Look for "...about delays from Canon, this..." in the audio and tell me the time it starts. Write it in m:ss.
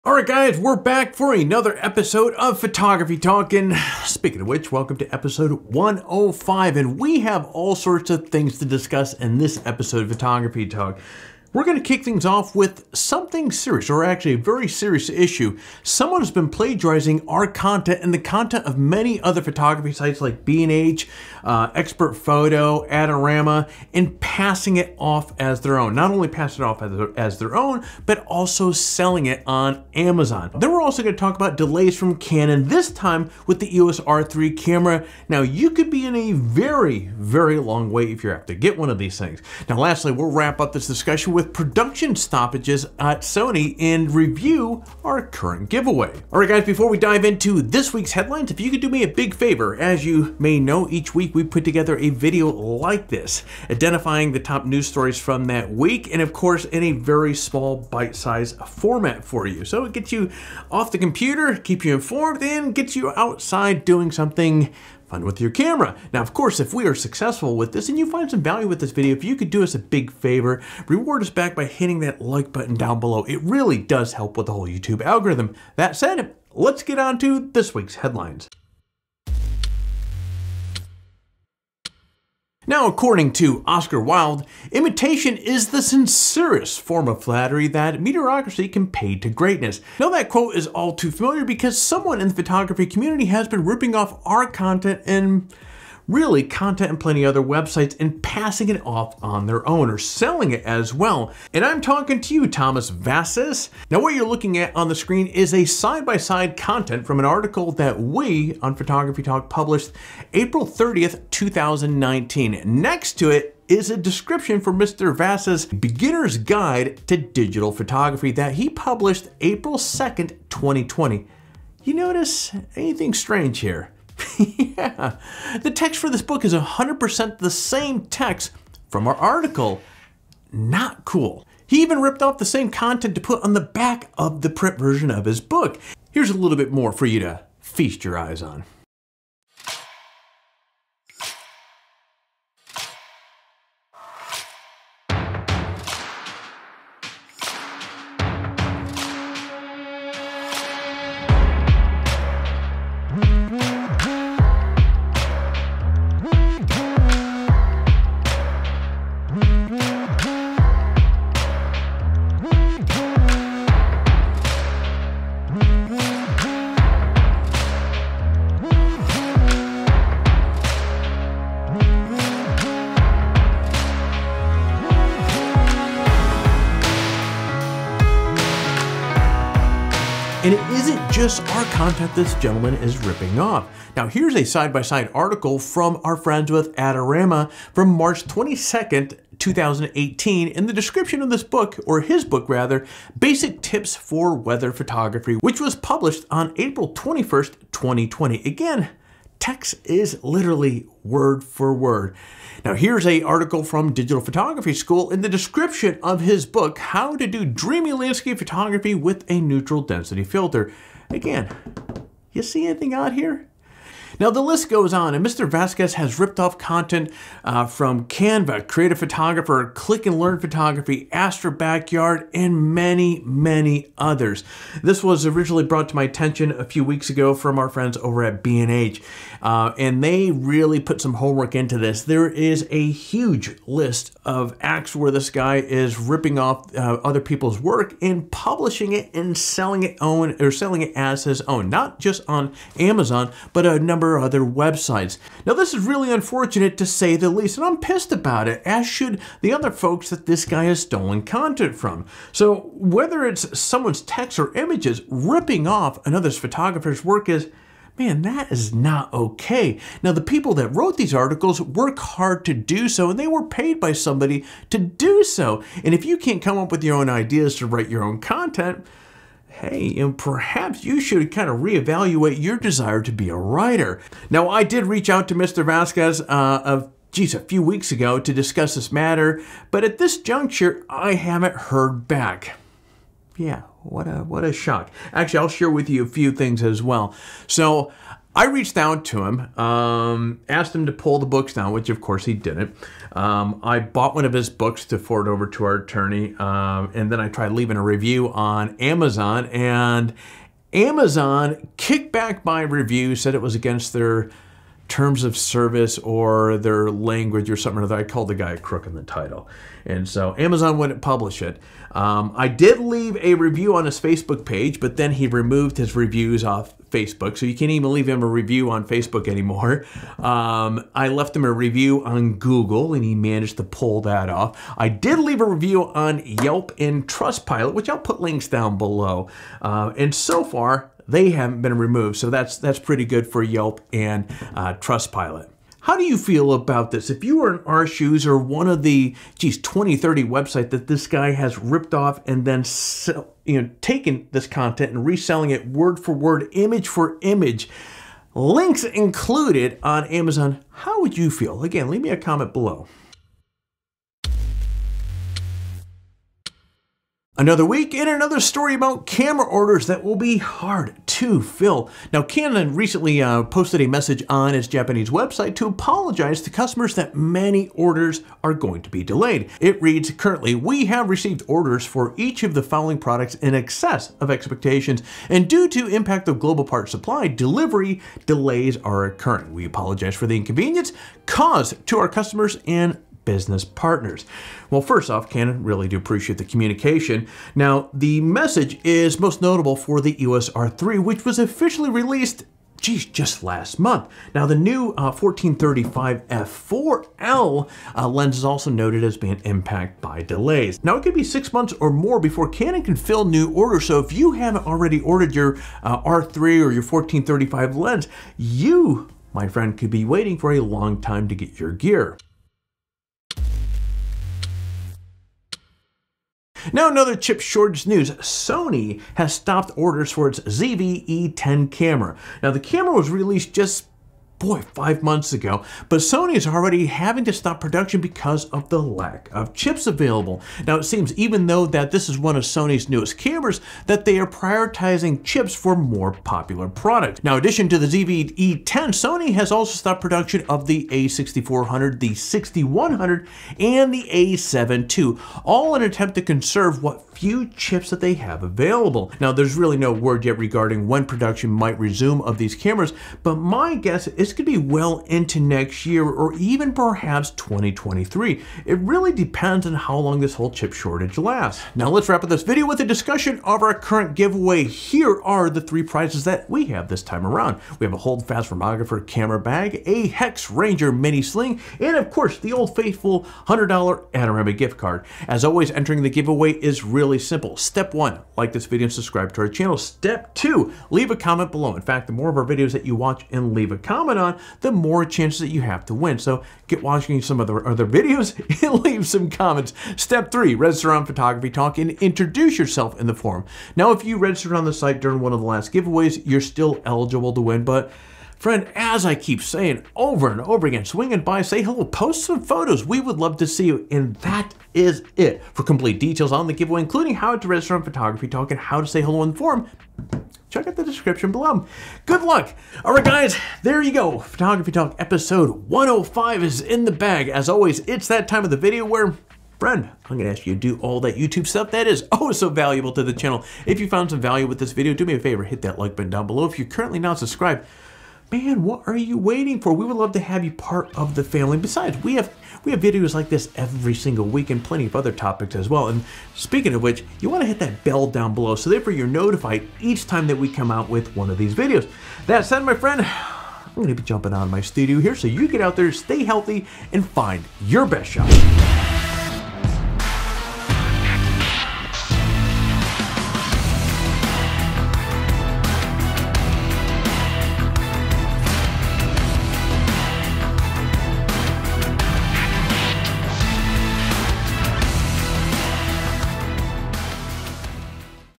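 0:31.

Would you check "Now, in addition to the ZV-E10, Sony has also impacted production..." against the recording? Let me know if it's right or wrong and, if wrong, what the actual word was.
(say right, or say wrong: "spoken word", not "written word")
wrong: "stopped", not "impacted".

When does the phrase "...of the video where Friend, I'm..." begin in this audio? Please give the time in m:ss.
8:38.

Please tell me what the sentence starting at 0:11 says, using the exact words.
We're going to kick things off with something serious, or actually a very serious issue.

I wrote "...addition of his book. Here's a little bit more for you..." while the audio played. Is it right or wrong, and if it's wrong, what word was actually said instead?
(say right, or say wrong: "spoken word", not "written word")
wrong: "version", not "addition".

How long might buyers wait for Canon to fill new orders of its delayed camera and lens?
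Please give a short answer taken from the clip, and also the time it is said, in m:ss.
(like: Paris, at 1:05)
six months or more, at 6:41.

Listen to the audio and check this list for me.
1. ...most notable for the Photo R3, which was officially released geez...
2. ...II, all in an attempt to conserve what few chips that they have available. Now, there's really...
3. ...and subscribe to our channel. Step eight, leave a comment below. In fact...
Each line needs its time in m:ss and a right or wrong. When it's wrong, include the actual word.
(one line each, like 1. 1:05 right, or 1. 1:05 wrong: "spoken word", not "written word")
1. 6:29 wrong: "EOS", not "Photo"
2. 7:24 right
3. 7:58 wrong: "two", not "eight".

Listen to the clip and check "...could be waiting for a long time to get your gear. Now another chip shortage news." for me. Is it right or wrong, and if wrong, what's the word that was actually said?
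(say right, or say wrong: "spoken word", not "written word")
right.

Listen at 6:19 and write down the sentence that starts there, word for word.
We apologize for the inconvenience caused to our customers and business partners.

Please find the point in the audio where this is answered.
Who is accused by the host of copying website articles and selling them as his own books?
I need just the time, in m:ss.
1:42.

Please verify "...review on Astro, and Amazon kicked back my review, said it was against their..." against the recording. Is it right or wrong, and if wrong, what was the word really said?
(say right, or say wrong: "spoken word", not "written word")
wrong: "Amazon", not "Astro".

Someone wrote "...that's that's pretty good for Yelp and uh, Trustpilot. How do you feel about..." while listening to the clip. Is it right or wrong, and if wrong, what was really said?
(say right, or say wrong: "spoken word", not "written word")
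right.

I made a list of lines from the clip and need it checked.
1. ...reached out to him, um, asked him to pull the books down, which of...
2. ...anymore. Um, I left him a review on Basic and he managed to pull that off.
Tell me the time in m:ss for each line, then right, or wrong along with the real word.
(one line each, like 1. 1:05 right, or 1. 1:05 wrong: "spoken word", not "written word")
1. 4:48 right
2. 5:19 wrong: "Google", not "Basic".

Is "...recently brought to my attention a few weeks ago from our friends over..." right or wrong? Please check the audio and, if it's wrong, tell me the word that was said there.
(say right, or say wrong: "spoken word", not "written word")
wrong: "originally", not "recently".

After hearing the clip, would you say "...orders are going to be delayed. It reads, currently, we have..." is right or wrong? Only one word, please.
right.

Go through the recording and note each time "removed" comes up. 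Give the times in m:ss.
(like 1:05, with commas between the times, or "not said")
5:15, 5:31.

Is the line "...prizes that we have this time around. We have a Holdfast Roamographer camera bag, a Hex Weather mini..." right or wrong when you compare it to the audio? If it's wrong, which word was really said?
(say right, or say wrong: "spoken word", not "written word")
wrong: "Ranger", not "Weather".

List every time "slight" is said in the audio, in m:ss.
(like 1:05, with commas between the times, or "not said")
not said.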